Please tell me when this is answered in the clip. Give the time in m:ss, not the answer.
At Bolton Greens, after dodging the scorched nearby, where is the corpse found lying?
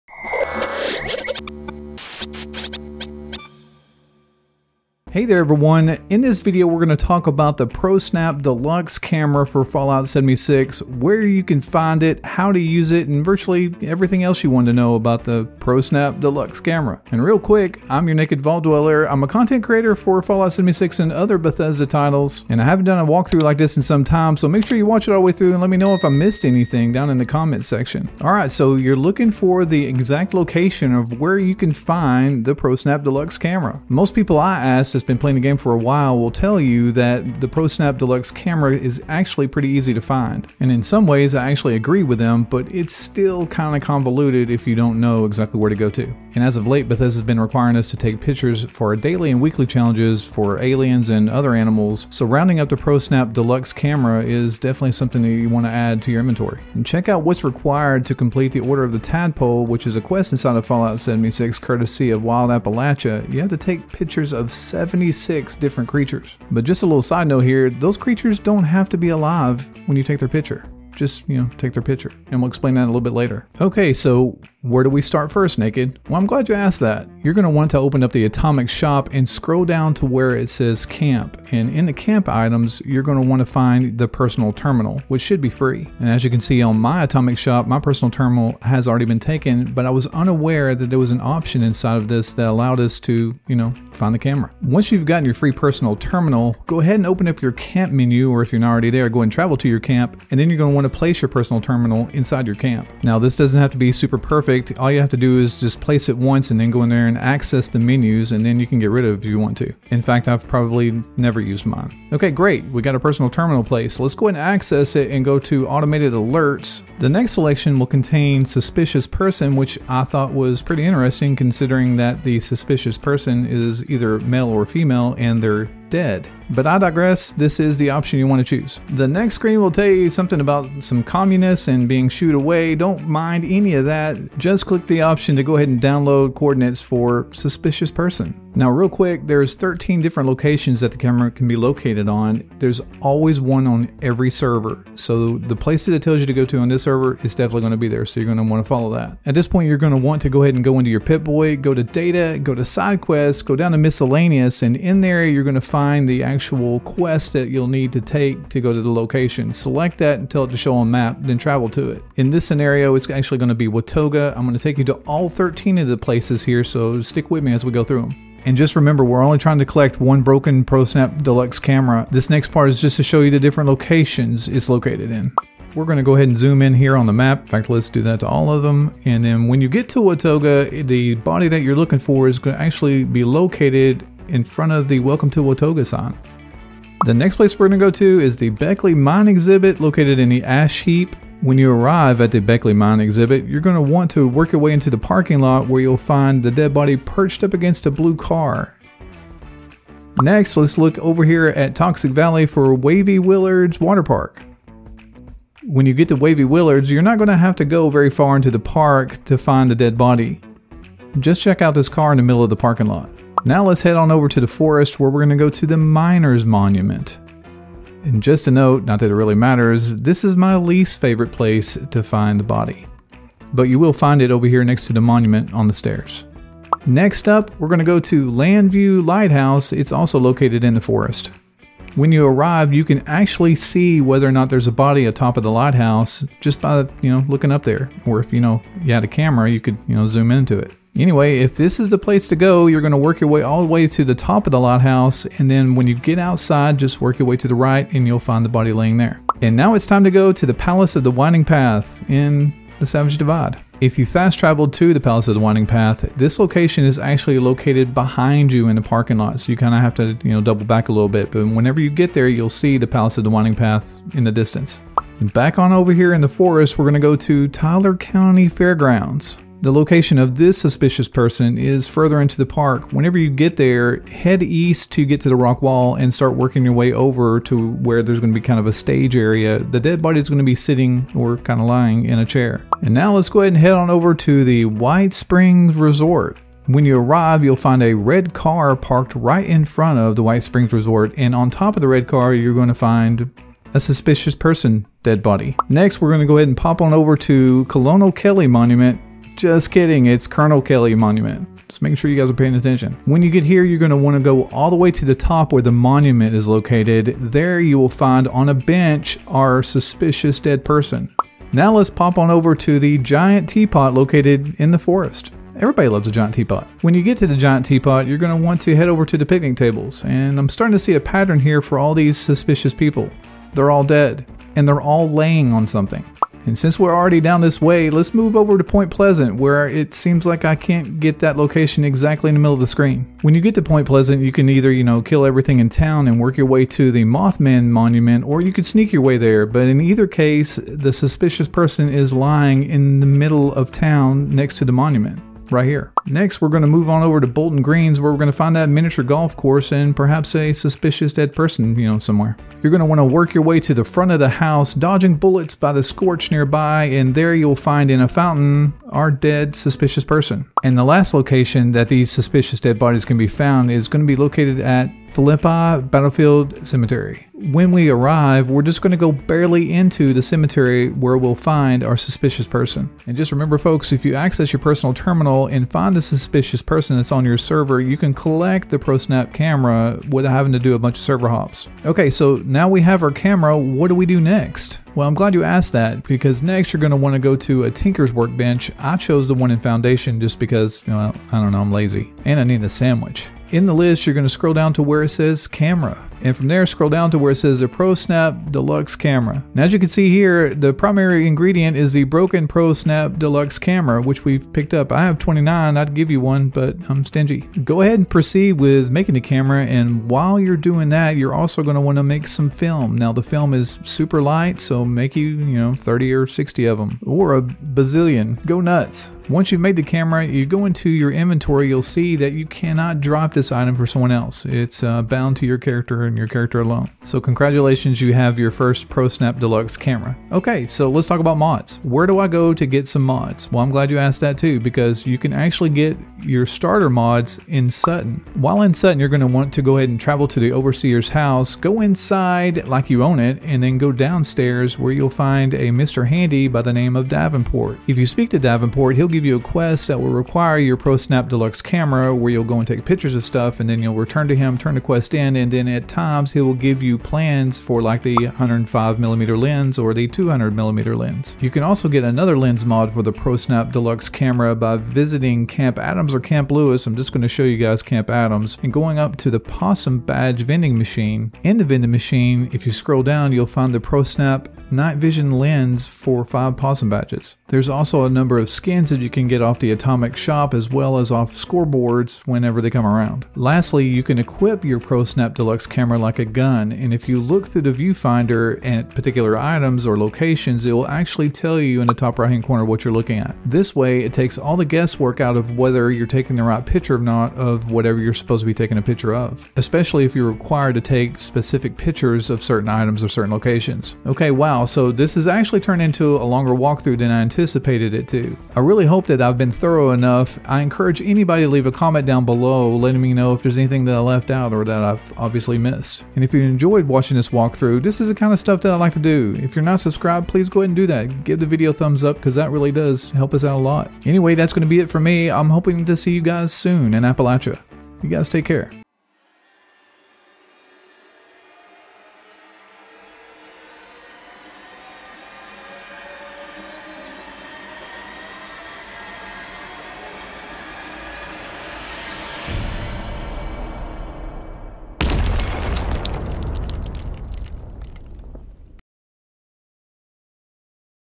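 5:58.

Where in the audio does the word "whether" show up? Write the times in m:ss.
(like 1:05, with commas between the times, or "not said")
3:54, 8:15.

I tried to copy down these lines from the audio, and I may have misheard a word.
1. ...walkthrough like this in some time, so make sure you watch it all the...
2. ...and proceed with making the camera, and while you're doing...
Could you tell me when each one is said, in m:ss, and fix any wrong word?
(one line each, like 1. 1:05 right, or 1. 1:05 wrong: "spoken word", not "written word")
1. 0:23 right
2. 6:47 right.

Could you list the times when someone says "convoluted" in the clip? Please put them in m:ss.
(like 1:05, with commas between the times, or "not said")
0:43.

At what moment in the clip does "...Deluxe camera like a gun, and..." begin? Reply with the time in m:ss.
8:05.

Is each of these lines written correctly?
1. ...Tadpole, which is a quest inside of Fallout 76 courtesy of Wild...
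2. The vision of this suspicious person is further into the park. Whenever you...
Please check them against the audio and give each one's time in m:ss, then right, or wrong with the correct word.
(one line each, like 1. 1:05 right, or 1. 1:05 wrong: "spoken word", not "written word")
1. 0:58 right
2. 4:29 wrong: "location", not "vision".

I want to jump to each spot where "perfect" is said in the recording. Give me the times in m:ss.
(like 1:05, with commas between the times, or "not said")
1:44.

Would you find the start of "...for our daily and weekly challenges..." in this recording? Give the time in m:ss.
0:48.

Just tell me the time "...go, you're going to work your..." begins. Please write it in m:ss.
4:02.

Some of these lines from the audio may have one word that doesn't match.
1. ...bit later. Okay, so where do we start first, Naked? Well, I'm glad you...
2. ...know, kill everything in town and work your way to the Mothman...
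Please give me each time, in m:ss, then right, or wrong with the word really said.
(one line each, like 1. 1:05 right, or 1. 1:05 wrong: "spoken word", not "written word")
1. 1:13 right
2. 5:34 right.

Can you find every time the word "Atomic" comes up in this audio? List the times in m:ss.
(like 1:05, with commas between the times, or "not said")
1:18, 1:27, 7:59.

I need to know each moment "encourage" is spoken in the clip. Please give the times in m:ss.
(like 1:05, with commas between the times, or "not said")
8:30.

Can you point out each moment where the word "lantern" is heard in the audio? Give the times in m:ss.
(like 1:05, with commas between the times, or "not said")
not said.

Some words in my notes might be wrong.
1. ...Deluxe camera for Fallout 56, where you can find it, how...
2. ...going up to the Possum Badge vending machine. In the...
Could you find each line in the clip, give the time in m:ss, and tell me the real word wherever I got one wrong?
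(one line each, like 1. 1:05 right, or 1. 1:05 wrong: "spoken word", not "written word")
1. 0:08 wrong: "76", not "56"
2. 7:48 right.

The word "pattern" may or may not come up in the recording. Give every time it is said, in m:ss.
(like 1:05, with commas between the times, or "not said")
5:20.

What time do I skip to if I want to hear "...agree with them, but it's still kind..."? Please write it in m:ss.
0:41.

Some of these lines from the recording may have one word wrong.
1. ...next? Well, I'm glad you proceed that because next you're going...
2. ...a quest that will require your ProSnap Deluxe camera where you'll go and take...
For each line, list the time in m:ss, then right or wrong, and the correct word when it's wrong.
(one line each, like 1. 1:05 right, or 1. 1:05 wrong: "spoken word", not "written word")
1. 6:24 wrong: "asked", not "proceed"
2. 7:29 right.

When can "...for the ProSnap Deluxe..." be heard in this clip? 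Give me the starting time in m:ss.
7:42.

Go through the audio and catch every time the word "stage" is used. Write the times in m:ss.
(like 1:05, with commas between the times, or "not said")
4:38.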